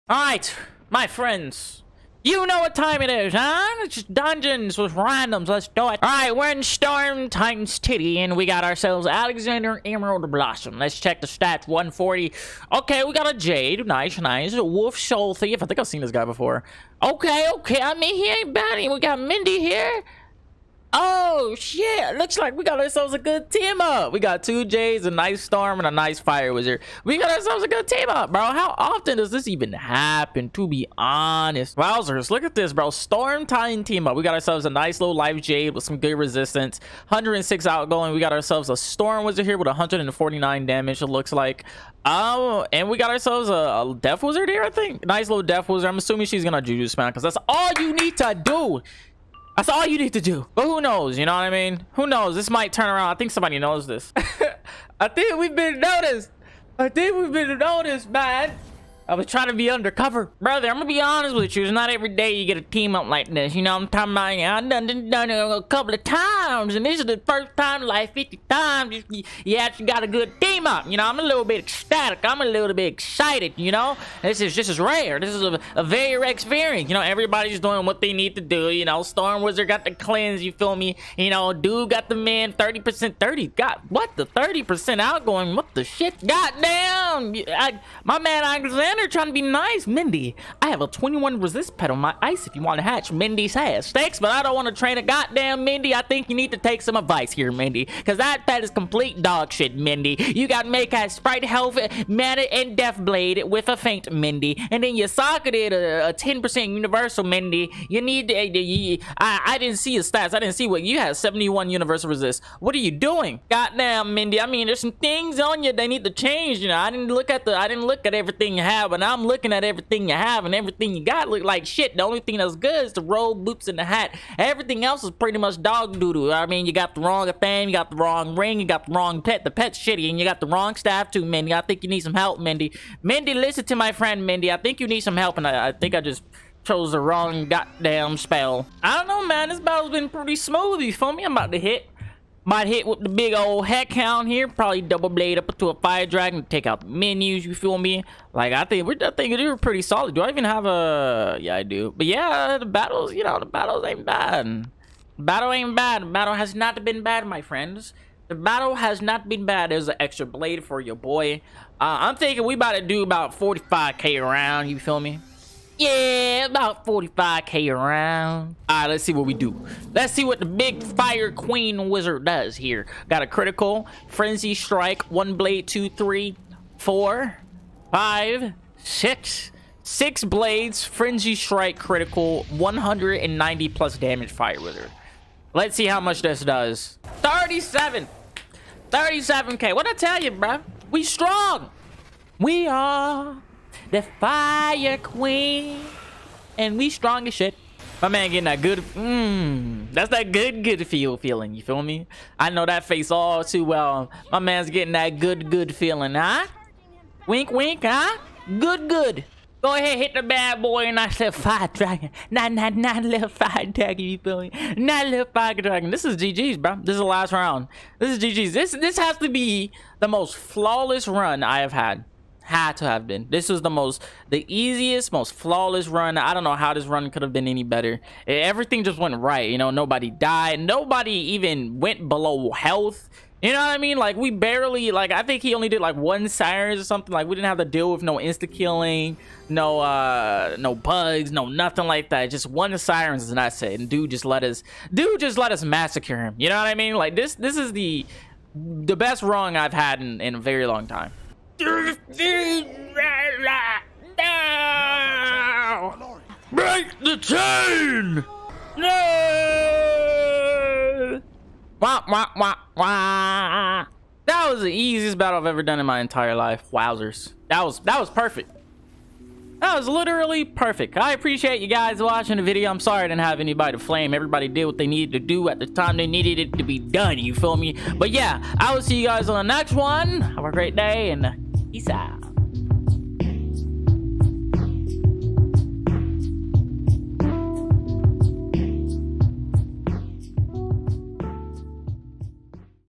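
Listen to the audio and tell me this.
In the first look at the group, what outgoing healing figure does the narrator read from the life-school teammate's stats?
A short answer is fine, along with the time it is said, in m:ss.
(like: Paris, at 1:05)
106, at 0:37.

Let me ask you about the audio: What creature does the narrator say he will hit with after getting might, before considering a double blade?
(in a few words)
Heckhound.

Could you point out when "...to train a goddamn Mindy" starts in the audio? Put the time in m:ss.
1:34.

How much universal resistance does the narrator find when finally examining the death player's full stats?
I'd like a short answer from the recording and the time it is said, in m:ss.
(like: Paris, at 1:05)
71, at 1:51.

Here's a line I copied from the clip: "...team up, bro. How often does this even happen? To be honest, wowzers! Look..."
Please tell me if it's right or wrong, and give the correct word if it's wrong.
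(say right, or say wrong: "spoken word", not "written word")
right.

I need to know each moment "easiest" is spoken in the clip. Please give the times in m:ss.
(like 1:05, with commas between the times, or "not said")
3:44, 4:24.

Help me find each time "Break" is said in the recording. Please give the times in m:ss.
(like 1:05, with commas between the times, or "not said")
4:16.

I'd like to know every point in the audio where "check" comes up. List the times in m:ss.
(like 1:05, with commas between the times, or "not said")
0:10.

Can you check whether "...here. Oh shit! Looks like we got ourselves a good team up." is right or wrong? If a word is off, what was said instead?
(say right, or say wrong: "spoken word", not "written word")
right.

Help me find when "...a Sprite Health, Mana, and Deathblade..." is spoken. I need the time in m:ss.
1:40.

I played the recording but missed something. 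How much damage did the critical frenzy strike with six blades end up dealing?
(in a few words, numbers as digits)
37k.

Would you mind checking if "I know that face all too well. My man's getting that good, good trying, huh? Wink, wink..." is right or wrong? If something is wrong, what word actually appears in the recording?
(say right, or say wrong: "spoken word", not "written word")
wrong: "feeling", not "trying".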